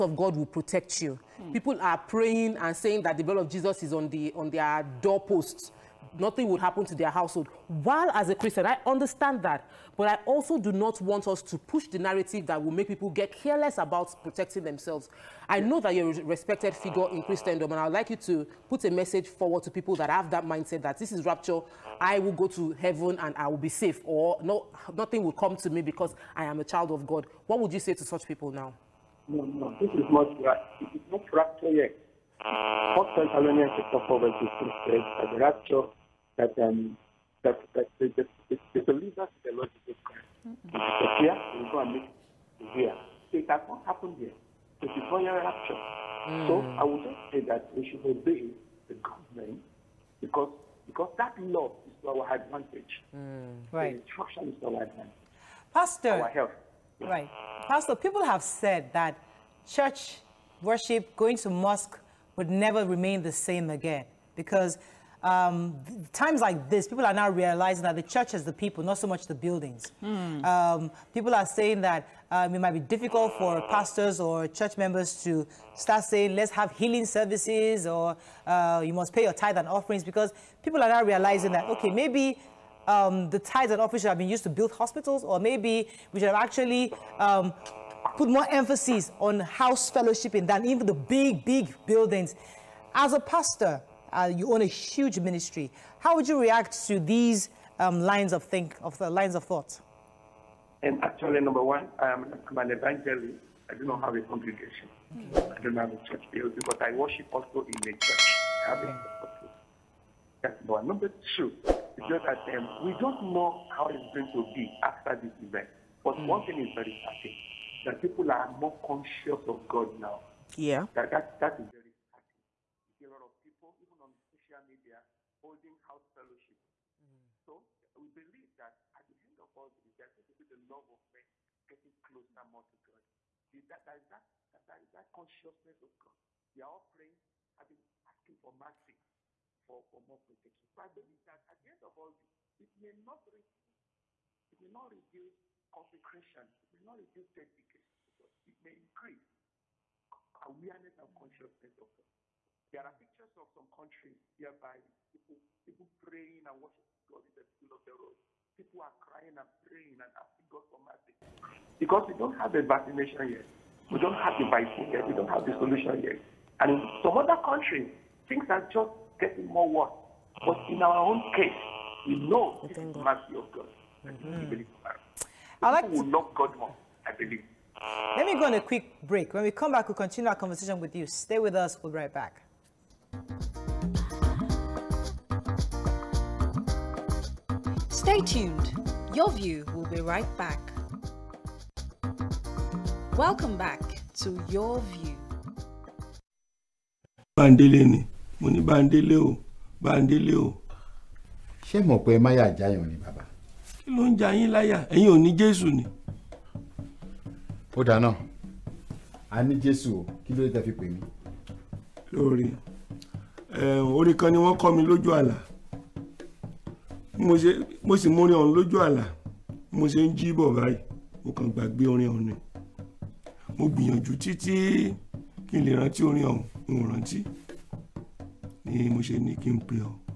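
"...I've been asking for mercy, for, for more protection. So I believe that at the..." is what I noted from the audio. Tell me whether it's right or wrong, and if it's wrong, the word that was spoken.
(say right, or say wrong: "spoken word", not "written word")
right.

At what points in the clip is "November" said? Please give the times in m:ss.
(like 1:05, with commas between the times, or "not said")
not said.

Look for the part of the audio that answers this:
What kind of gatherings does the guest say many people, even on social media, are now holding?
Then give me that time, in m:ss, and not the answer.
2:05.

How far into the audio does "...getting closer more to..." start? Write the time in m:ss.
2:11.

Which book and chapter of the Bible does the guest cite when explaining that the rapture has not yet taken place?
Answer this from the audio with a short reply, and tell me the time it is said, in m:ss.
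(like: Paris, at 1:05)
Thessalonians chapter 4, at 0:33.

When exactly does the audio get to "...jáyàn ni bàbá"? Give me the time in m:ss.
3:22.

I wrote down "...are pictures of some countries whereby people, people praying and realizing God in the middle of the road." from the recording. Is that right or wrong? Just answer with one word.
wrong.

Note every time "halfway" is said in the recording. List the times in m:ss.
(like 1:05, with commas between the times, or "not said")
not said.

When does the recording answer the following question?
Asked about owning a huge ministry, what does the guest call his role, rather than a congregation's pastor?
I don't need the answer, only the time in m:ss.
1:42.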